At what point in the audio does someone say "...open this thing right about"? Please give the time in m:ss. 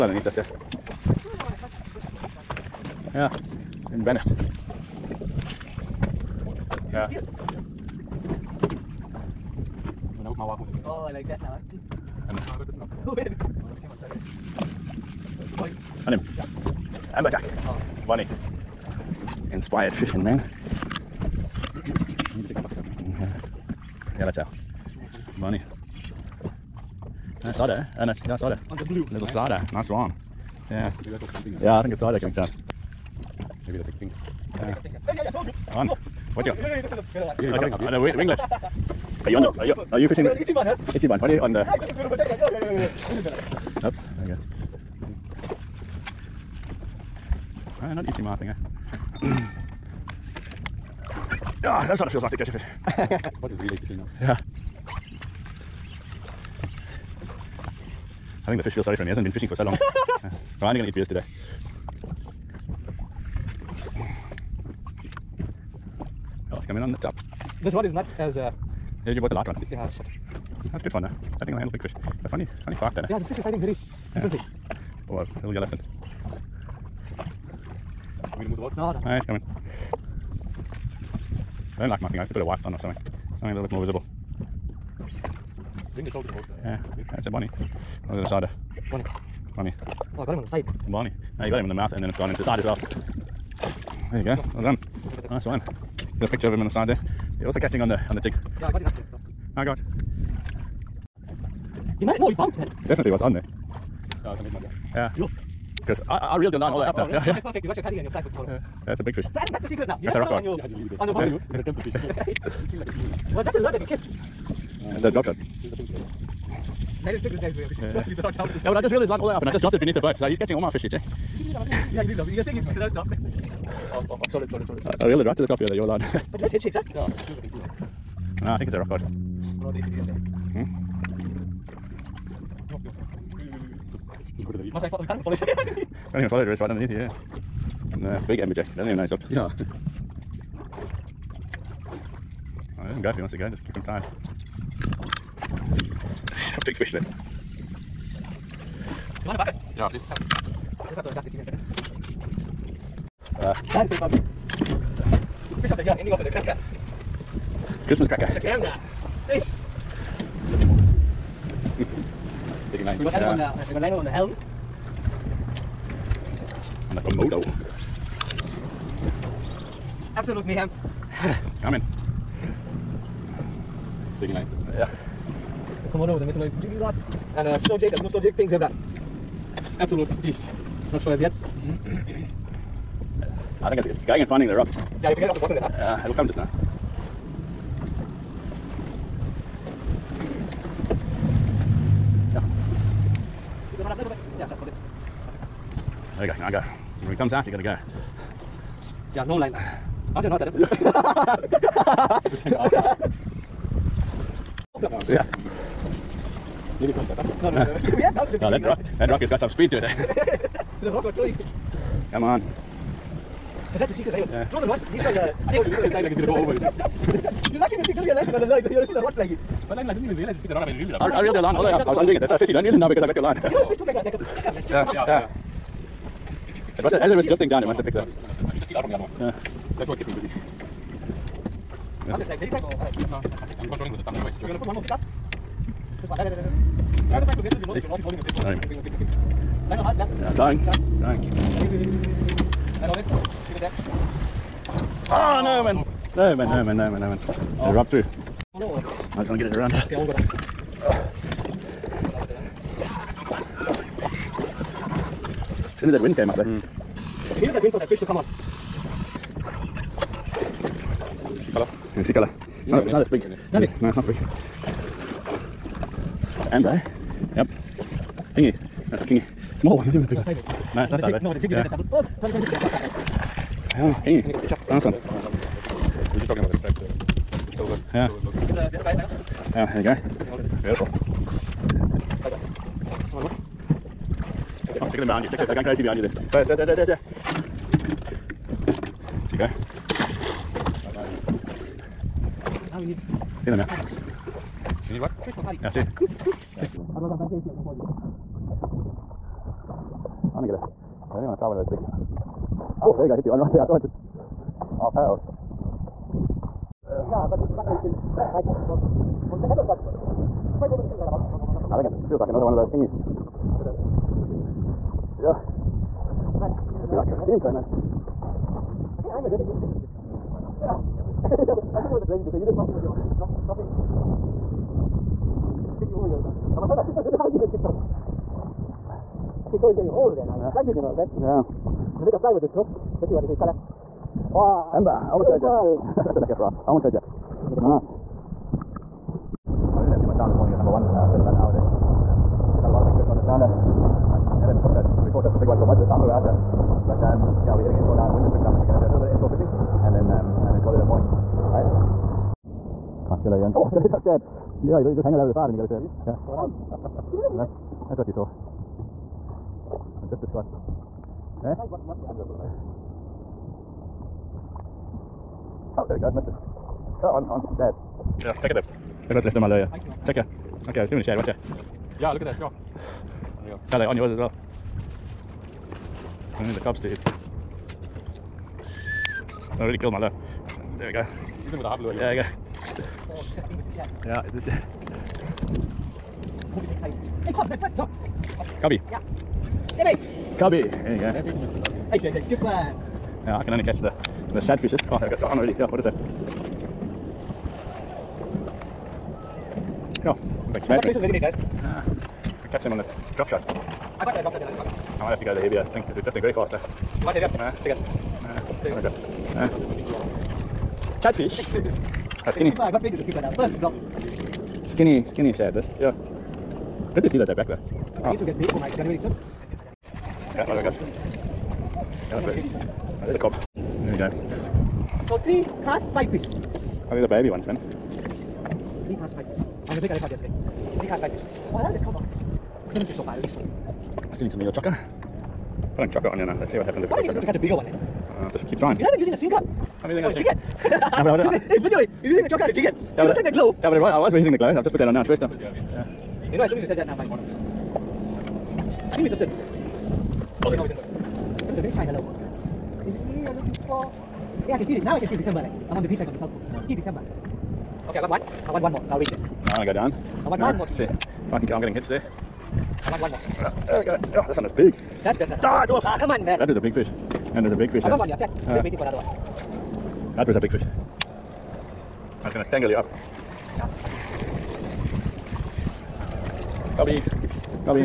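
5:10.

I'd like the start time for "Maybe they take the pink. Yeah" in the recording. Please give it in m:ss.
0:33.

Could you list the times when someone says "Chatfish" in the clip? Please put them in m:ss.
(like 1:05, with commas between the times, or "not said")
6:51.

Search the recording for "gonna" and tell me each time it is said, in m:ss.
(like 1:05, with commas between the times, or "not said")
1:51, 3:36, 5:00, 5:31, 7:09, 7:52.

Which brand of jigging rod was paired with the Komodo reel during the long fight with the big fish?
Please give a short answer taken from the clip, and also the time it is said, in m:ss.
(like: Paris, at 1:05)
Metaloid, at 2:56.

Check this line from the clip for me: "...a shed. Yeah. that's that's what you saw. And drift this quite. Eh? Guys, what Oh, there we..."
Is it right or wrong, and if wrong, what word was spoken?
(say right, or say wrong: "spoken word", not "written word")
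right.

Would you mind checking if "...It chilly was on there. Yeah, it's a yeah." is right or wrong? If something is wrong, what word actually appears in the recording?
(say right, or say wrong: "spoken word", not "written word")
wrong: "definitely", not "chilly".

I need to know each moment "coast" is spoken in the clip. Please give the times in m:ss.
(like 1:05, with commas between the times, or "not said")
7:36.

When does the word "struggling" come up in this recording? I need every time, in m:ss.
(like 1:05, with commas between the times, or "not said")
5:30.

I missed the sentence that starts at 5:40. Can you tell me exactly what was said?
Uh, spent about an hour there.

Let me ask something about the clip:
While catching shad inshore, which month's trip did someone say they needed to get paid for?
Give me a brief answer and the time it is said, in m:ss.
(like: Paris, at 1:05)
January, at 6:58.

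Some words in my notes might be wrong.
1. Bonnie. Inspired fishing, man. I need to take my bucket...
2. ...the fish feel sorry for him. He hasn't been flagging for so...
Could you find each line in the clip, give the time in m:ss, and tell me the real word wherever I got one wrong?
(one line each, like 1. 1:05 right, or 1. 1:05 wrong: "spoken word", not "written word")
1. 0:18 right
2. 0:58 wrong: "fishing", not "flagging".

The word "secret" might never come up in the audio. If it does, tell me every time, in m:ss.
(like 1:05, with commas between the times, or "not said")
1:49, 3:33.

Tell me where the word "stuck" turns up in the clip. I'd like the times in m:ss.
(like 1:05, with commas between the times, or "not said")
3:27.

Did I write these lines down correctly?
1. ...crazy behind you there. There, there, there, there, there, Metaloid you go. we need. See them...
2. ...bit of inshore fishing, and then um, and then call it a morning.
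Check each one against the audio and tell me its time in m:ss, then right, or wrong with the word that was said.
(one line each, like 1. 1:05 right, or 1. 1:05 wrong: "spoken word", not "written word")
1. 4:45 wrong: "There", not "Metaloid"
2. 5:49 right.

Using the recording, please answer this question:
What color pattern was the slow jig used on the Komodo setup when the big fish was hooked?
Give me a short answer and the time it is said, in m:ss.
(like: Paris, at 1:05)
pink zebra, at 2:58.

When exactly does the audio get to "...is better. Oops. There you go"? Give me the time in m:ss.
0:43.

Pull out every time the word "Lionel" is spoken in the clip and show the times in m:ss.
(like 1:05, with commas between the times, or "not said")
2:43, 3:39, 3:59.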